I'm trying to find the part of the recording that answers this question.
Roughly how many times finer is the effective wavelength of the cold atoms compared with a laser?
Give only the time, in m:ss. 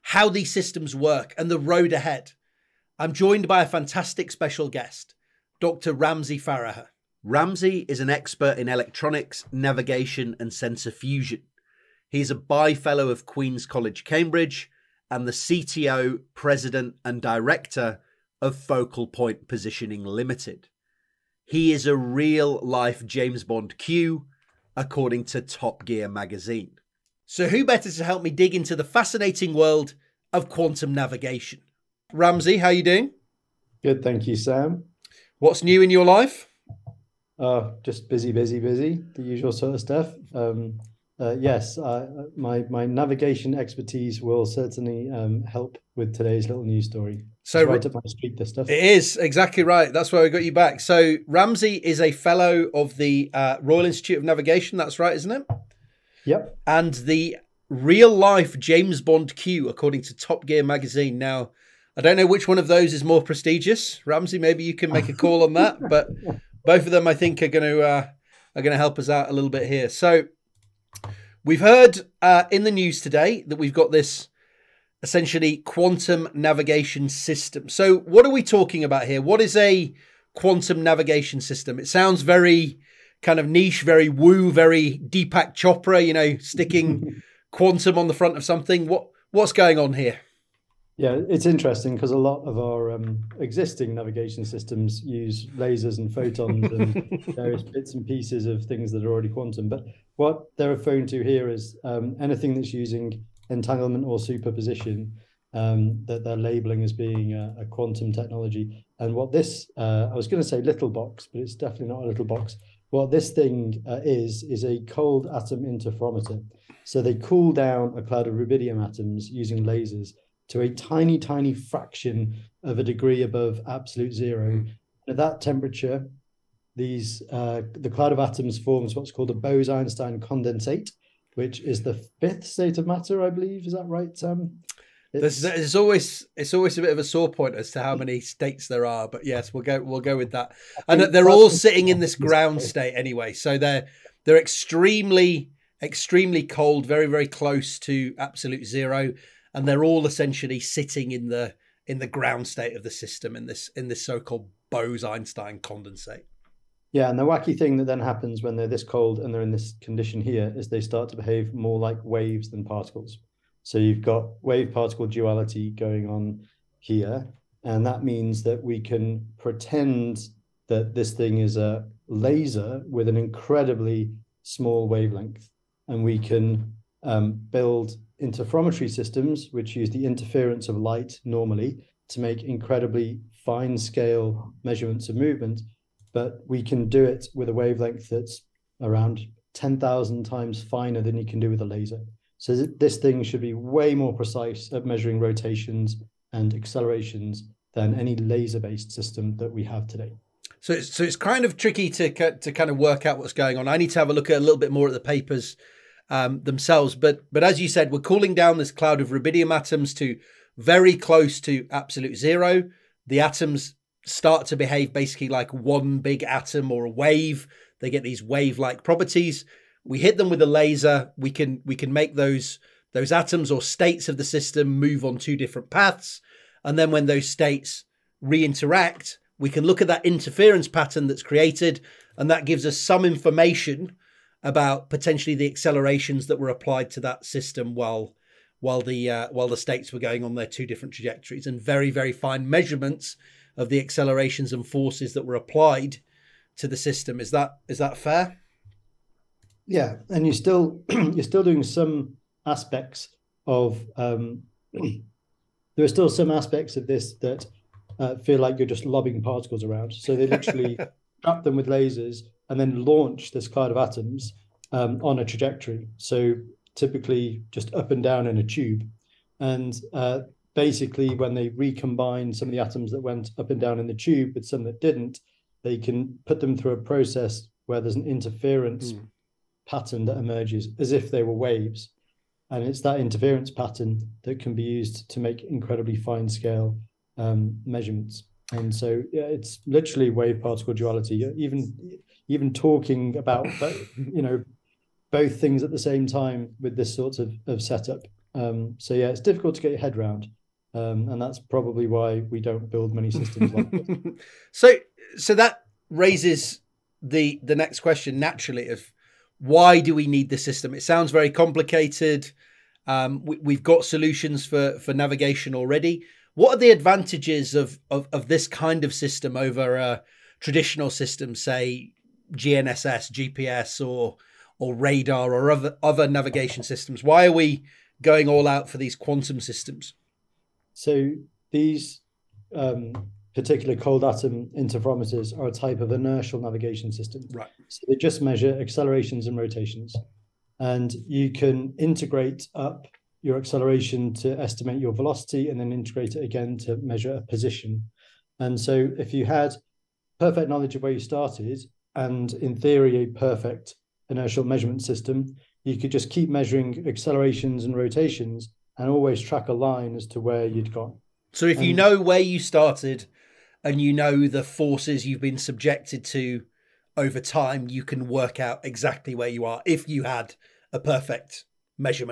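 3:09.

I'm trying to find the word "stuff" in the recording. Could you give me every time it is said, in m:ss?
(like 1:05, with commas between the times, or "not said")
0:39, 0:48.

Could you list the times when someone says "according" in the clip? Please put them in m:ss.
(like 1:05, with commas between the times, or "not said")
0:24, 0:59.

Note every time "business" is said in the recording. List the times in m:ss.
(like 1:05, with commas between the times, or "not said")
not said.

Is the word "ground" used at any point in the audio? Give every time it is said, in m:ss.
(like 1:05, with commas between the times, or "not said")
2:22, 2:32.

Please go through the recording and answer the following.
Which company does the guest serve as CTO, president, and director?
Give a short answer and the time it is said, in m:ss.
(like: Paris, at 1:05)
Focal Point Positioning Limited, at 0:18.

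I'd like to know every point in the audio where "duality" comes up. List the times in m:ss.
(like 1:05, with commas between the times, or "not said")
2:45, 4:50.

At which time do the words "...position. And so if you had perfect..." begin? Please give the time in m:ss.
5:47.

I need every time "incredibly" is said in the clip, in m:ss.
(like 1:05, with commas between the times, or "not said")
2:53, 3:02, 4:45.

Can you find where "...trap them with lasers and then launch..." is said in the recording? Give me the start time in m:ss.
4:21.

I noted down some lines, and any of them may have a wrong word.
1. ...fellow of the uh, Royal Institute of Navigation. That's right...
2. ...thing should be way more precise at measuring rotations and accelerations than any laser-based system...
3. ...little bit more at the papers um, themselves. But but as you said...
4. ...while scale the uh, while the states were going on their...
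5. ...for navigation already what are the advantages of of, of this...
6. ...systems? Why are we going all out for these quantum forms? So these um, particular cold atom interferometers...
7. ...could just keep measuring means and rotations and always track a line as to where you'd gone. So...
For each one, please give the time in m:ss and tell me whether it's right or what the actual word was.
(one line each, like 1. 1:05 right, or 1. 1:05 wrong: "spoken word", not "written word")
1. 0:52 right
2. 3:12 right
3. 3:24 right
4. 3:57 wrong: "while", not "scale"
5. 5:14 right
6. 5:26 wrong: "systems", not "forms"
7. 5:55 wrong: "accelerations", not "means".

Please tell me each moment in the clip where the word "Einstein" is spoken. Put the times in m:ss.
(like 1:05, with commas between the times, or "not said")
2:09, 2:34.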